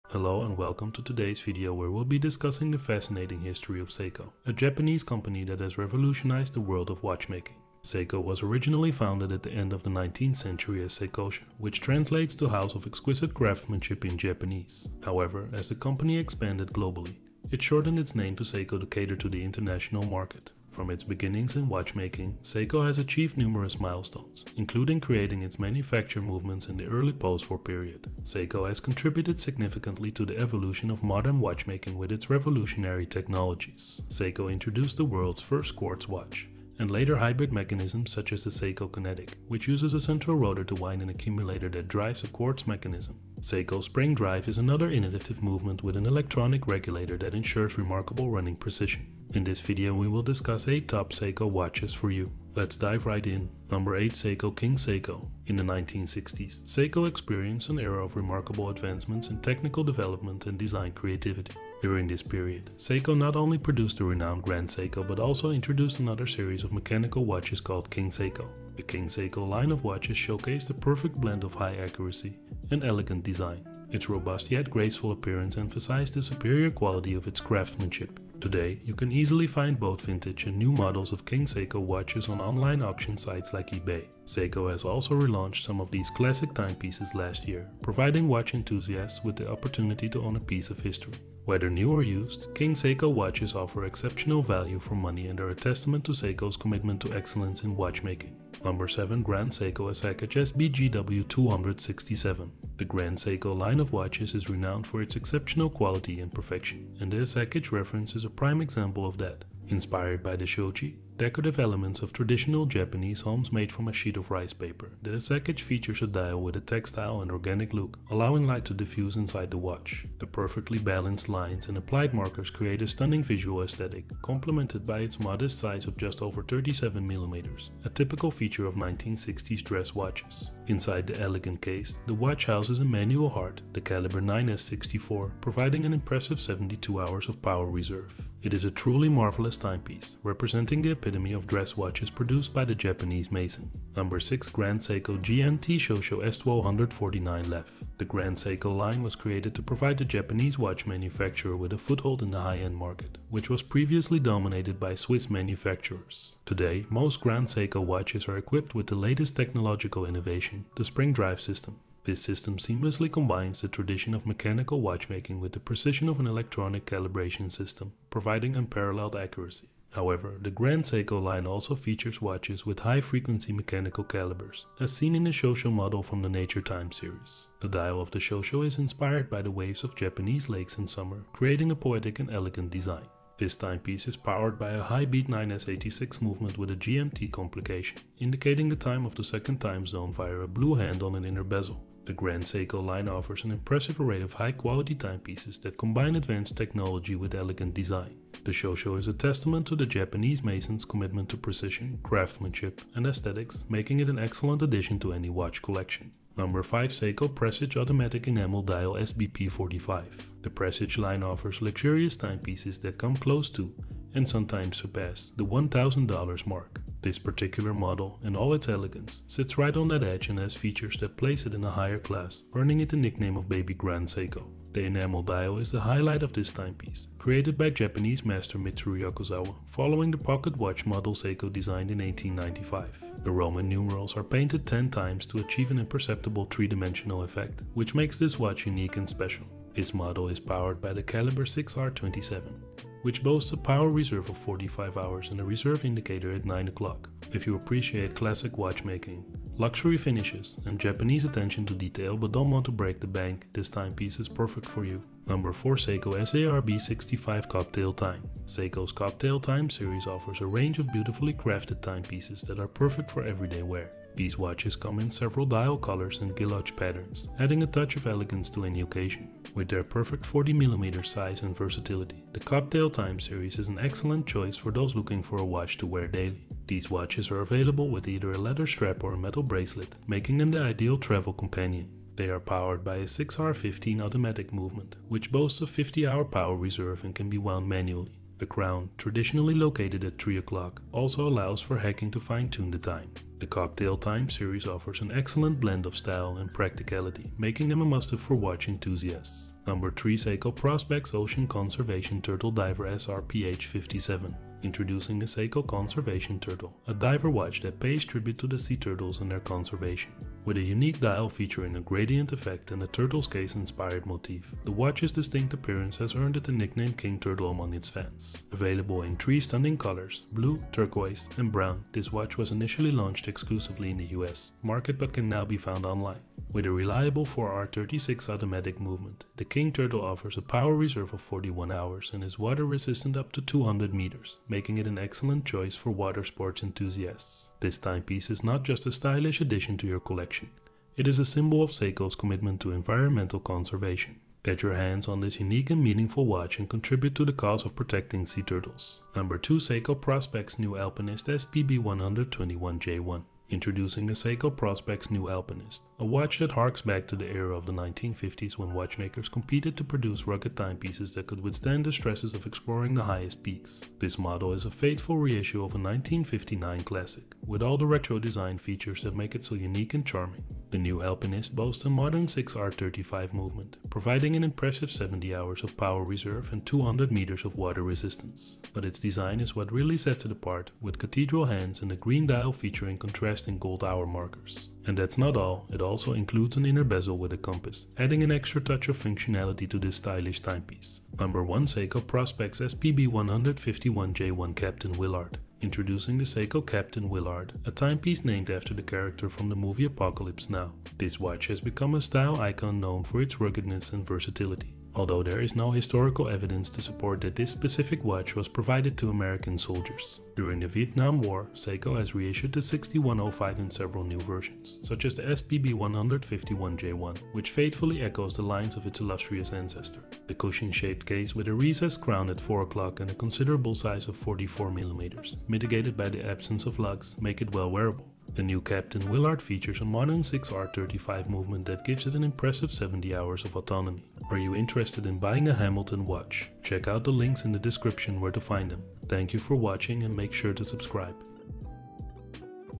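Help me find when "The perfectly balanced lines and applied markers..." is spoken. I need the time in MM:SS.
02:00.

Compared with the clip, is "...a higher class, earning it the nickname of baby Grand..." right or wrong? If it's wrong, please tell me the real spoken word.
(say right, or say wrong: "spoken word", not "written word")
right.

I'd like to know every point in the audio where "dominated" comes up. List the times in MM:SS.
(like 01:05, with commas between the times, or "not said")
02:34.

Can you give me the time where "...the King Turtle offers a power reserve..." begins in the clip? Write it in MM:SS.
05:29.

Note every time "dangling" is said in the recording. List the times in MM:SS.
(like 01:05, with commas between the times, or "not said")
not said.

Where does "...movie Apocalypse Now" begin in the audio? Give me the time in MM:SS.
06:39.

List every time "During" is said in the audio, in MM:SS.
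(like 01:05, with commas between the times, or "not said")
01:01, 06:50.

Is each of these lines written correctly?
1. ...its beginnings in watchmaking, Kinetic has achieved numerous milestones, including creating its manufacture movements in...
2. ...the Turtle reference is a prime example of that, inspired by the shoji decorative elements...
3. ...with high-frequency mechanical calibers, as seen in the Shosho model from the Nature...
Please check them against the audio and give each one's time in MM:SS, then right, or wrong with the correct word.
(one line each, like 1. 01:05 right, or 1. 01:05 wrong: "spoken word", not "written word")
1. 00:20 wrong: "Seiko", not "Kinetic"
2. 01:47 wrong: "Asakage", not "Turtle"
3. 02:52 right.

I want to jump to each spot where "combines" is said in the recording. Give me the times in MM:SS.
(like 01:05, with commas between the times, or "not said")
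02:43, 03:15.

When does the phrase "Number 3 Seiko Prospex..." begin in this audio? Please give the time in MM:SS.
04:59.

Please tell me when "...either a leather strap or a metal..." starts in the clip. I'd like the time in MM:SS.
04:38.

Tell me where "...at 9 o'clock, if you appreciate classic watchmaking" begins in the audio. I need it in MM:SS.
04:06.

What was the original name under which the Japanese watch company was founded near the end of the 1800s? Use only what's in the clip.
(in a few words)
Seikosha.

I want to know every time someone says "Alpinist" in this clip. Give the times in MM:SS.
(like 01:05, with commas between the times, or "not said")
05:50, 05:55, 06:11.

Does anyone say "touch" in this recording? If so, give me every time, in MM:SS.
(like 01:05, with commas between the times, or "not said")
04:27, 06:28.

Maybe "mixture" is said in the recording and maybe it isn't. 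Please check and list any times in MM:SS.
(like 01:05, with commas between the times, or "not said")
not said.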